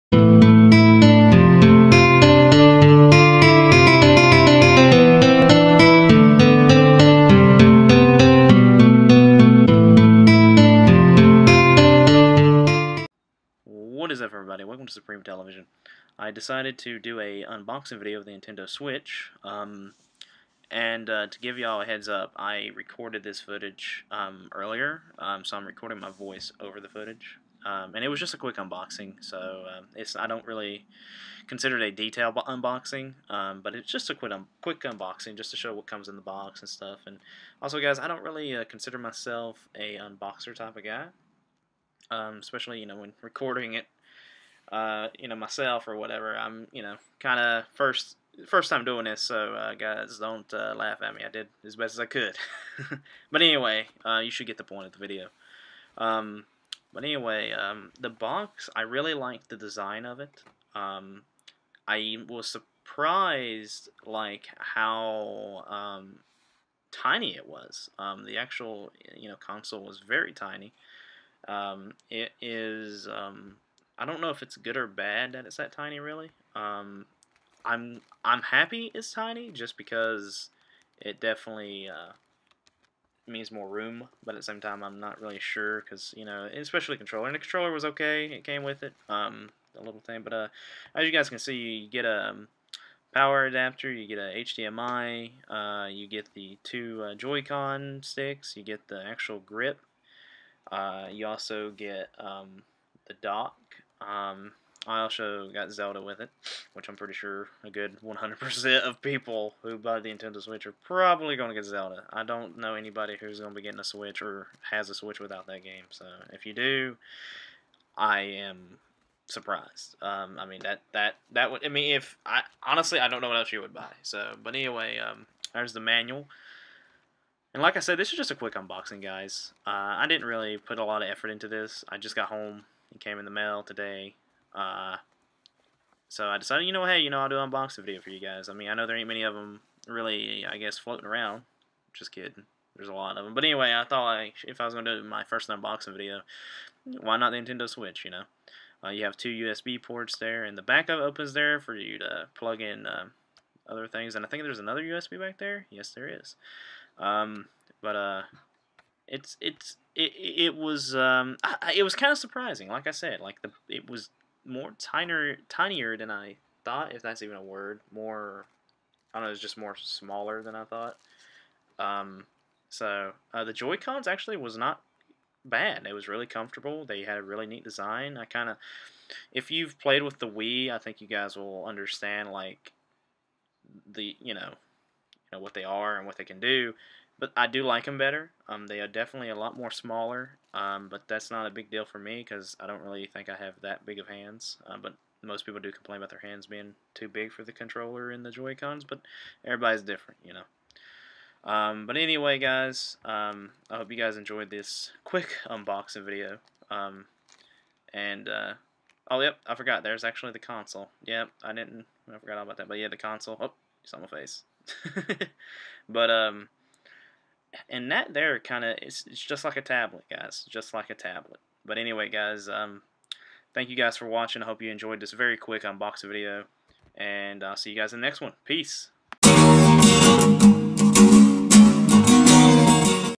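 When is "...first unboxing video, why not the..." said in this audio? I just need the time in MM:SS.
02:25.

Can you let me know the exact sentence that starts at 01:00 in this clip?
Um, I was surprised, like, how um, tiny it was.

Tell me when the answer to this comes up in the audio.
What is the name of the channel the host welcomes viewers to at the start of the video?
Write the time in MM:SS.
00:14.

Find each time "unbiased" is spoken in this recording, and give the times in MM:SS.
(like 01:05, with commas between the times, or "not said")
not said.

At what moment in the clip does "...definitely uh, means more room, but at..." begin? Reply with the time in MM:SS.
01:21.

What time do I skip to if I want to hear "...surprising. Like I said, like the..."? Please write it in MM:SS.
02:42.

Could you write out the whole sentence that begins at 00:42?
Um, especially you know when recording it uh, you know, myself or whatever.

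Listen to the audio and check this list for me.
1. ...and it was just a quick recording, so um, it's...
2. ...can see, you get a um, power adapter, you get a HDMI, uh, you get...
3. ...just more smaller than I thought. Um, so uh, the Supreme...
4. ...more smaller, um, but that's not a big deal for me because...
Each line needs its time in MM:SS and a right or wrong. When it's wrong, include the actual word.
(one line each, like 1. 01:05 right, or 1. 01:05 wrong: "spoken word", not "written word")
1. 00:27 wrong: "unboxing", not "recording"
2. 01:31 right
3. 02:49 wrong: "Joy", not "Supreme"
4. 03:09 right.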